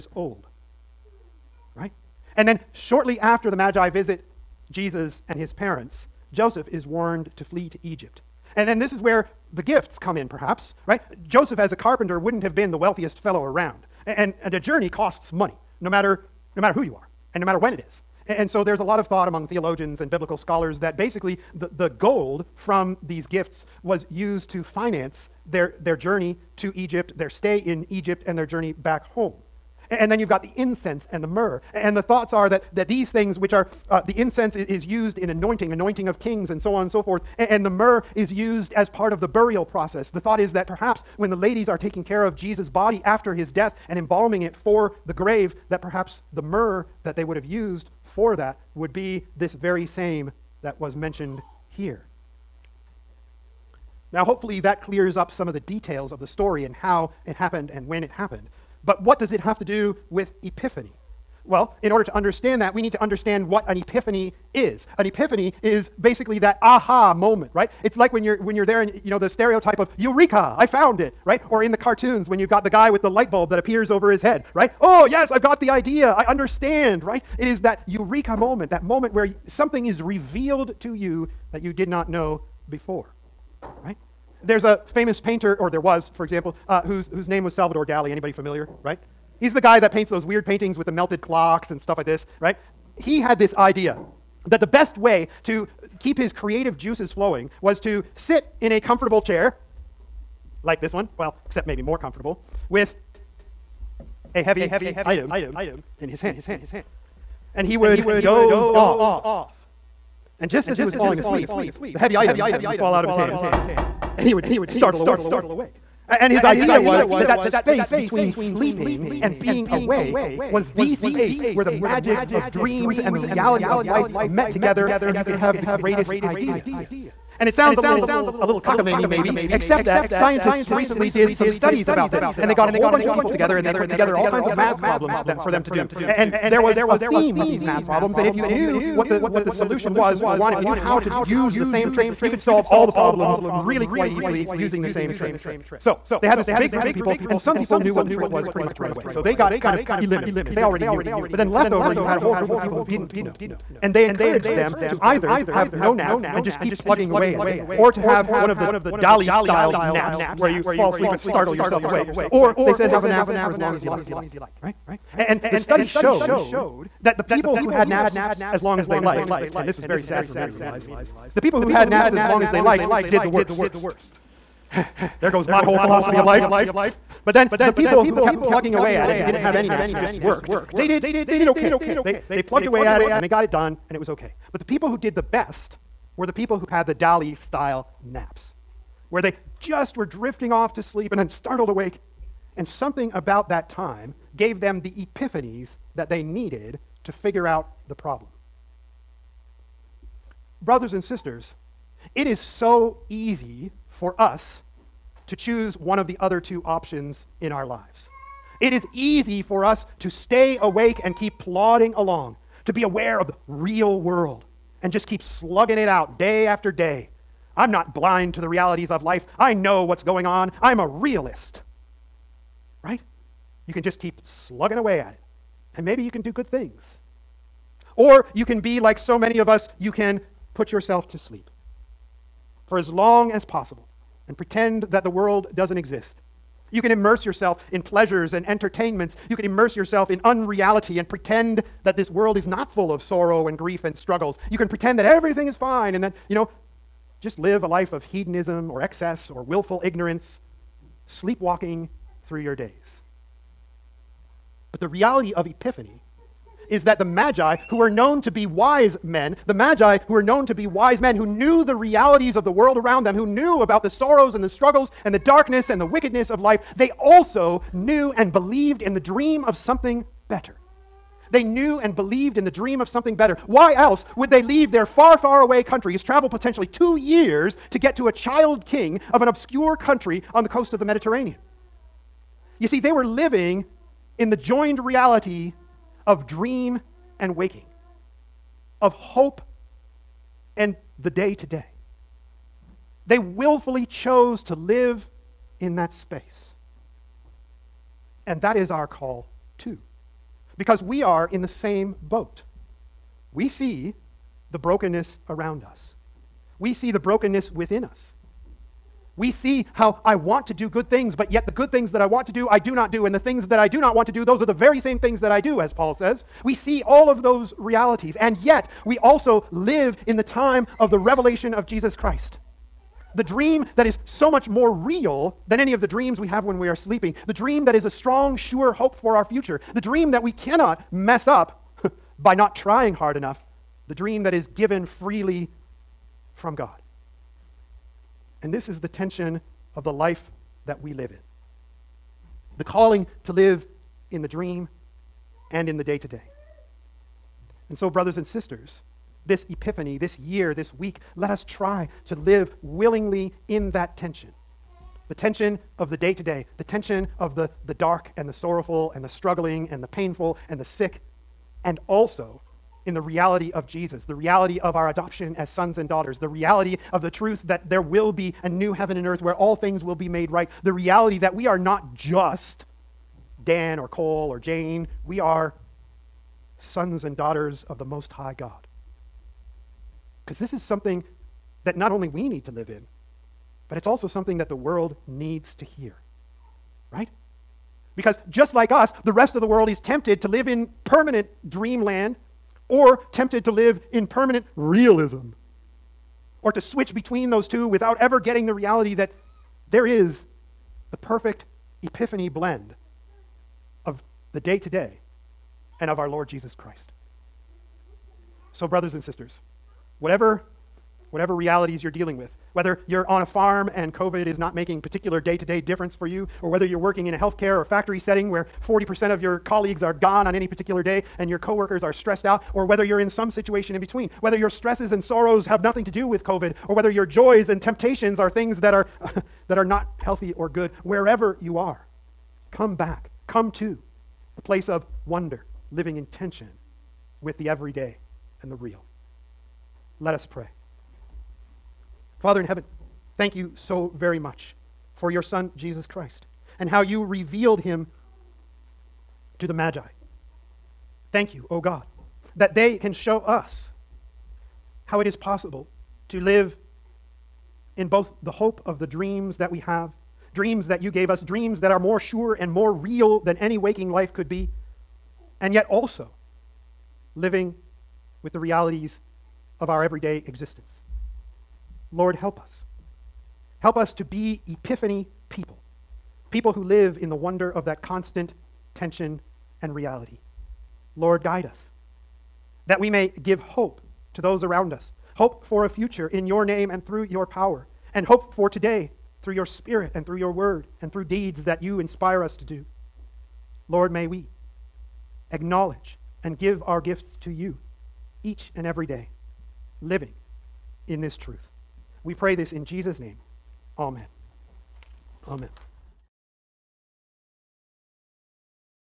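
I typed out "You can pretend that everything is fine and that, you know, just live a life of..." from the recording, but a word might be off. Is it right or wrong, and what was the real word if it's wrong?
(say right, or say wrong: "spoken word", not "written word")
right.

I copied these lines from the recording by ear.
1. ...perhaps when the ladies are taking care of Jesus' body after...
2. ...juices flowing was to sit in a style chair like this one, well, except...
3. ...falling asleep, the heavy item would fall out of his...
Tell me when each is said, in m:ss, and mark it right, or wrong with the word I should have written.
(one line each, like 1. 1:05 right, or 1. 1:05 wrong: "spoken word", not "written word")
1. 0:40 right
2. 1:36 wrong: "comfortable", not "style"
3. 1:50 right.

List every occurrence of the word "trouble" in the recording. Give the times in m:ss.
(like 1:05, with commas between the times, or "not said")
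not said.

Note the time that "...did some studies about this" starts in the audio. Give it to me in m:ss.
2:11.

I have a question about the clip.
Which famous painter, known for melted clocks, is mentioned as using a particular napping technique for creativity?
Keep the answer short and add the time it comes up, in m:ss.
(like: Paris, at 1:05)
Salvador Dali, at 1:27.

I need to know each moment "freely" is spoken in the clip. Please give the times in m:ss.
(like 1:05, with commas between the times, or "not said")
5:34.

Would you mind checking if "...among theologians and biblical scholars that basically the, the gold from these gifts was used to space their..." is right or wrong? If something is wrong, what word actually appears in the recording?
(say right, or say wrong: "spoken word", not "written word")
wrong: "finance", not "space".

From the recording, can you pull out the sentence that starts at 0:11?
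Joseph, as a carpenter, wouldn't have been the wealthiest fellow around.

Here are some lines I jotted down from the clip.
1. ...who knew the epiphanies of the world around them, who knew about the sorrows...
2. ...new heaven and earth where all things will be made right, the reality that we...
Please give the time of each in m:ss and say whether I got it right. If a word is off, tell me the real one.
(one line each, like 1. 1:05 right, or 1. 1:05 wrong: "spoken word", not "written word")
1. 4:21 wrong: "realities", not "epiphanies"
2. 6:08 right.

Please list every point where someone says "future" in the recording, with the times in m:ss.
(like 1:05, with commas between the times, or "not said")
5:29, 8:05.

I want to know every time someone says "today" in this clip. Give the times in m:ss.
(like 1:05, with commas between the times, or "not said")
4:51, 8:08.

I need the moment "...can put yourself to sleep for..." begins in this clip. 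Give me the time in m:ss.
3:49.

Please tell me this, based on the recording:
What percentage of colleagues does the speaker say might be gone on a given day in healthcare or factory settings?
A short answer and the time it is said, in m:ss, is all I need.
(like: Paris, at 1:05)
40%, at 6:58.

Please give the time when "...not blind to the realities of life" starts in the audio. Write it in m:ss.
3:37.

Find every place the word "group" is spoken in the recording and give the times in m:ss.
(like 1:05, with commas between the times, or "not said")
2:26, 2:32.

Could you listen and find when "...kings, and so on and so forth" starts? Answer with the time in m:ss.
0:36.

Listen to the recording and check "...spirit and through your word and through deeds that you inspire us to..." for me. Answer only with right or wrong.
right.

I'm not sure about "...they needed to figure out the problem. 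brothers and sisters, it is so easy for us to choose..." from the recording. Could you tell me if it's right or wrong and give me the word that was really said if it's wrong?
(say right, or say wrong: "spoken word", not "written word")
right.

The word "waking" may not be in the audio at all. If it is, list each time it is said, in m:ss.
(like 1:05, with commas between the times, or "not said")
4:47, 7:43.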